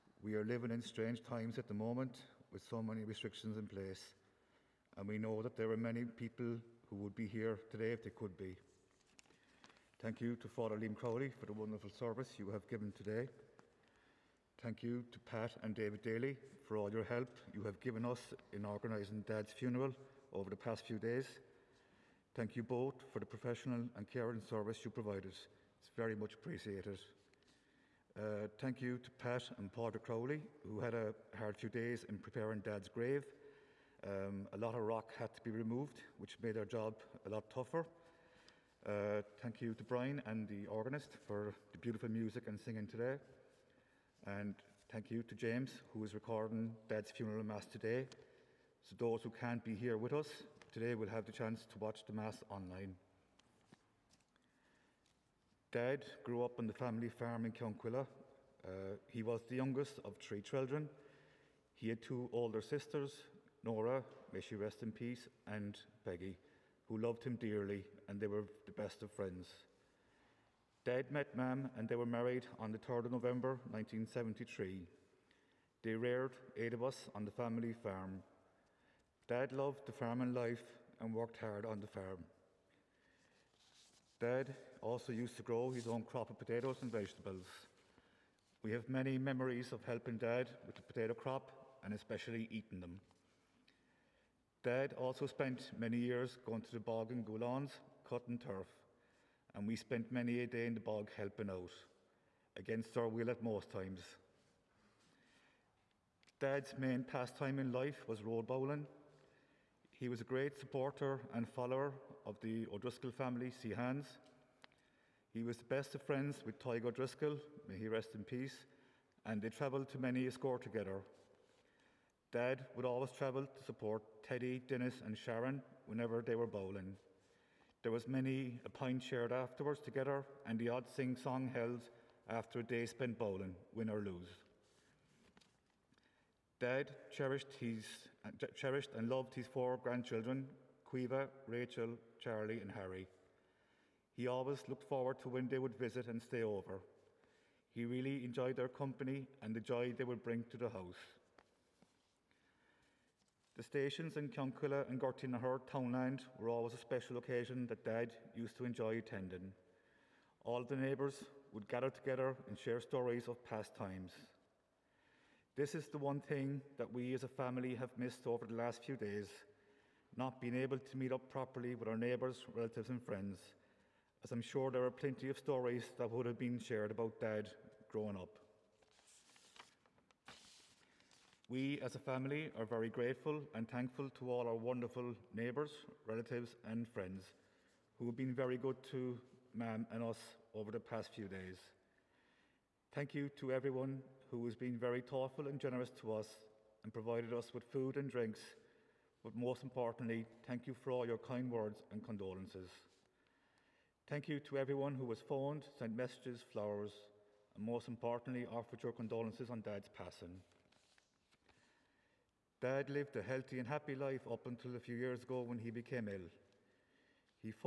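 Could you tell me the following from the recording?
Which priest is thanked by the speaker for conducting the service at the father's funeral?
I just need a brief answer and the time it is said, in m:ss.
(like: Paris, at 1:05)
Father Liam Crowley, at 0:10.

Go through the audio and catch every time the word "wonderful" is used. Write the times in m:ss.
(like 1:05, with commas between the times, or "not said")
0:11, 3:04.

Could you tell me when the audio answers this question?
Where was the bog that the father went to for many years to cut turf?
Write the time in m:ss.
1:37.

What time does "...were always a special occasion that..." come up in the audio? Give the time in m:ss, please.
2:36.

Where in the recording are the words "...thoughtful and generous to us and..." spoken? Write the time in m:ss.
3:15.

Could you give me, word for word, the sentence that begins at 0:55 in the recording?
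Dad grew up on the family farm in Counkilla.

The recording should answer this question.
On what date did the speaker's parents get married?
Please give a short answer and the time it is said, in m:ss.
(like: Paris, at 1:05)
3 November 1973, at 1:12.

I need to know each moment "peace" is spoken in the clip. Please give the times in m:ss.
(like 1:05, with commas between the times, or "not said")
1:04, 1:58.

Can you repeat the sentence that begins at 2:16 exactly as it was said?
Dad cherished, his, uh, cherished and loved his four grandchildren, Caoimhe, Rachel, Charlie, and Harry.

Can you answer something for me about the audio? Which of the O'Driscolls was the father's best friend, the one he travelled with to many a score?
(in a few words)
Tig O'Driscoll.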